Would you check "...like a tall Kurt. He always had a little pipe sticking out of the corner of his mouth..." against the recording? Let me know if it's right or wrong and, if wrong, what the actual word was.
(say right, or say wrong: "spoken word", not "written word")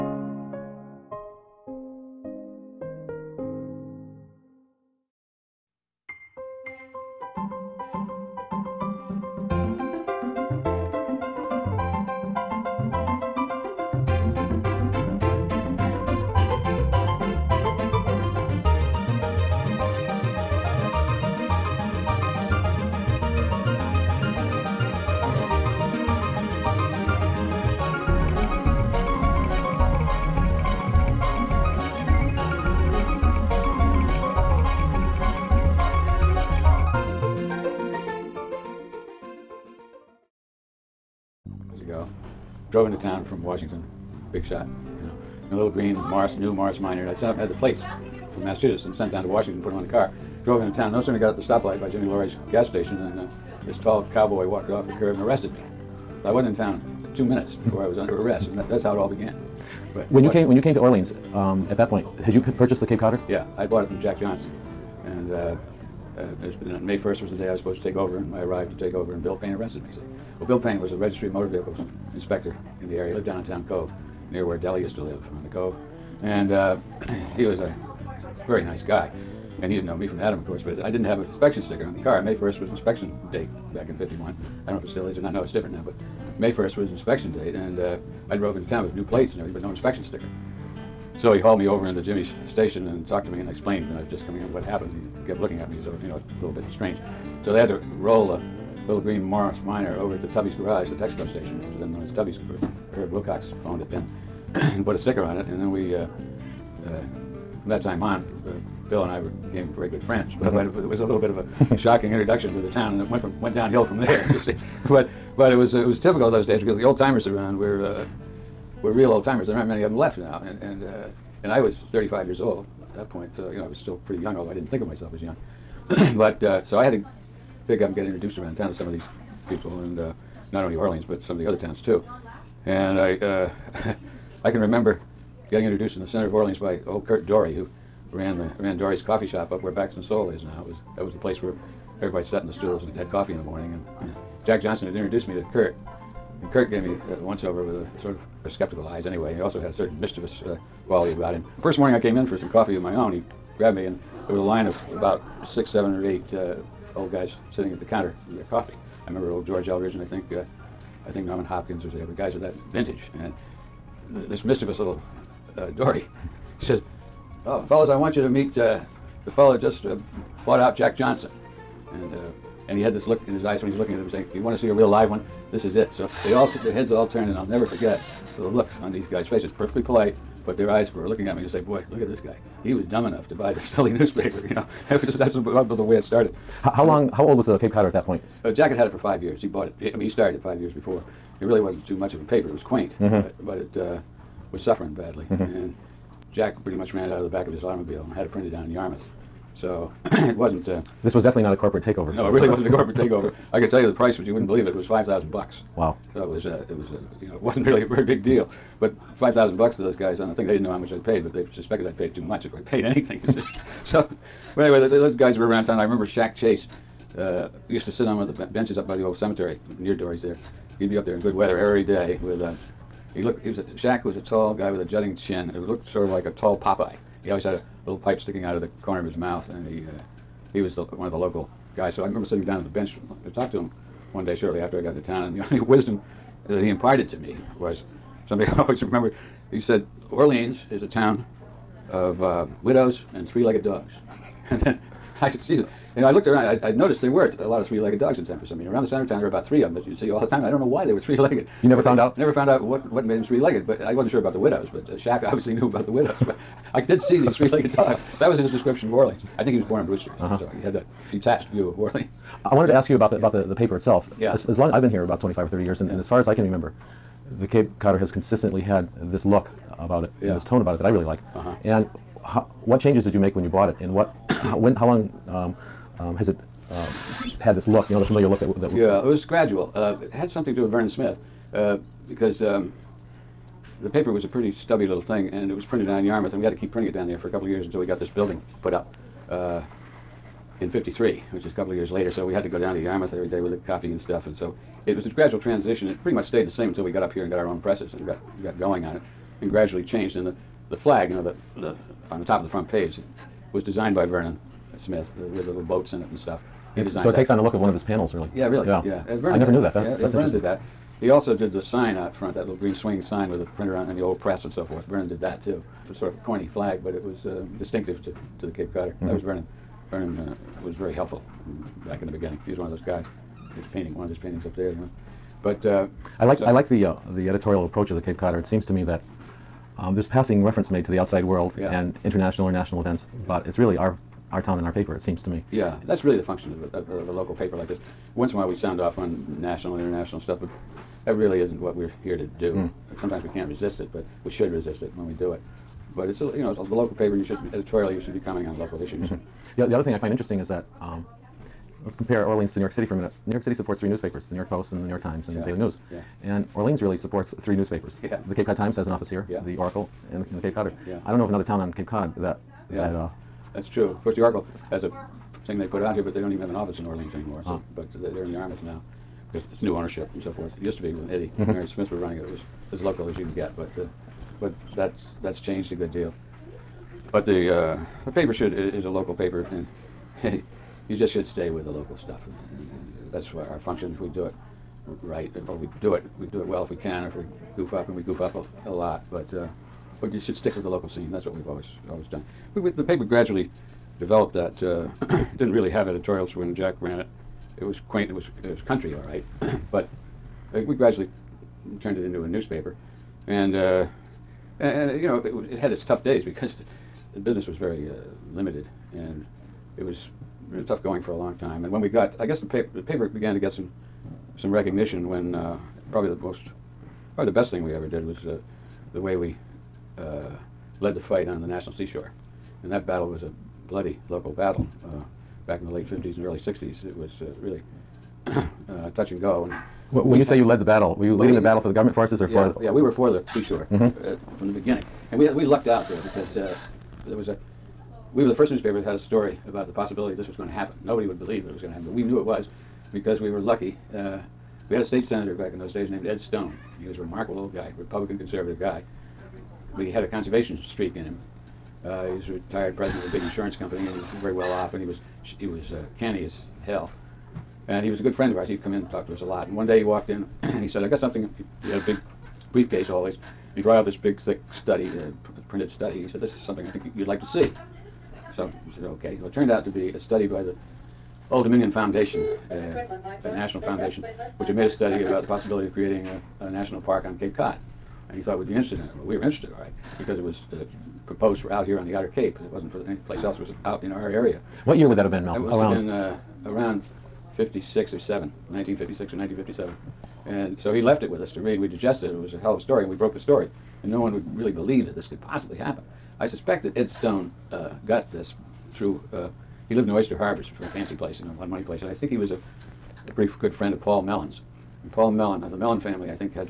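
wrong: "Popeye", not "Kurt".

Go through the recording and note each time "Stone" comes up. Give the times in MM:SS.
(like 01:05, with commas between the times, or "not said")
07:26, 08:16.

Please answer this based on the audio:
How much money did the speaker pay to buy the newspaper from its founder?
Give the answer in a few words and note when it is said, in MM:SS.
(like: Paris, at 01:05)
$5,000, at 03:24.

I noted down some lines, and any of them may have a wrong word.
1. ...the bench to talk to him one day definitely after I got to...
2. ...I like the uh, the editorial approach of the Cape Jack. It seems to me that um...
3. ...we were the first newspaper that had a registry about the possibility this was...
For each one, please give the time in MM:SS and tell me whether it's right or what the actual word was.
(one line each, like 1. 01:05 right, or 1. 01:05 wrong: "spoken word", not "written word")
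1. 03:52 wrong: "shortly", not "definitely"
2. 05:26 wrong: "Codder", not "Jack"
3. 07:18 wrong: "story", not "registry".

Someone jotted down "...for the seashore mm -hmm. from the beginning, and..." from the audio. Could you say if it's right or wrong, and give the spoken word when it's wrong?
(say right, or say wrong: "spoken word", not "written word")
right.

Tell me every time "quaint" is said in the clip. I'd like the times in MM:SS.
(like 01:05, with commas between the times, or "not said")
03:12, 06:37.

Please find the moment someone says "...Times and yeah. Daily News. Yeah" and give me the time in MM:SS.
05:55.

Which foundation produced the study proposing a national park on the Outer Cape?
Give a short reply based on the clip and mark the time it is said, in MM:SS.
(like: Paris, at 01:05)
Old Dominion Foundation, at 07:51.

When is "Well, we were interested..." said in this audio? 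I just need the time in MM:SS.
07:58.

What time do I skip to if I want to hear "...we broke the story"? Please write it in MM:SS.
08:12.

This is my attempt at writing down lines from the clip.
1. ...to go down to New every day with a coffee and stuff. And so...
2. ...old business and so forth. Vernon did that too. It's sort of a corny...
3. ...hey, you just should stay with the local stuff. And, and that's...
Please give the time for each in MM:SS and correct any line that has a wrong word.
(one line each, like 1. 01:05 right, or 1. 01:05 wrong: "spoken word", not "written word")
1. 04:52 wrong: "Yarmouth", not "New"
2. 05:14 wrong: "press", not "business"
3. 06:20 right.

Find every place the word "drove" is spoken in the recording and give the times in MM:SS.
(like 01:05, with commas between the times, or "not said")
00:42, 00:50, 01:28.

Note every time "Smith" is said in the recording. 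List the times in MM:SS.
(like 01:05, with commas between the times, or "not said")
04:40, 05:04, 06:11.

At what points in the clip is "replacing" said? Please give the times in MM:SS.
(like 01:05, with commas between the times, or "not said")
not said.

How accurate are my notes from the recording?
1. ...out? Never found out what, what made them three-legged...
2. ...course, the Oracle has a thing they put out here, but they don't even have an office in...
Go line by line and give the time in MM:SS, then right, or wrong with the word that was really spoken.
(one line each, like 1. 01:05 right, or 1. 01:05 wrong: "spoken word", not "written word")
1. 04:11 right
2. 06:04 right.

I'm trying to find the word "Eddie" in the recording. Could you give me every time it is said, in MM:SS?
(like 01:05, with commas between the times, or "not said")
06:11.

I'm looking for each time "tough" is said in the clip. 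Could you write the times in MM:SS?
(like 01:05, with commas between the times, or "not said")
06:45, 06:50.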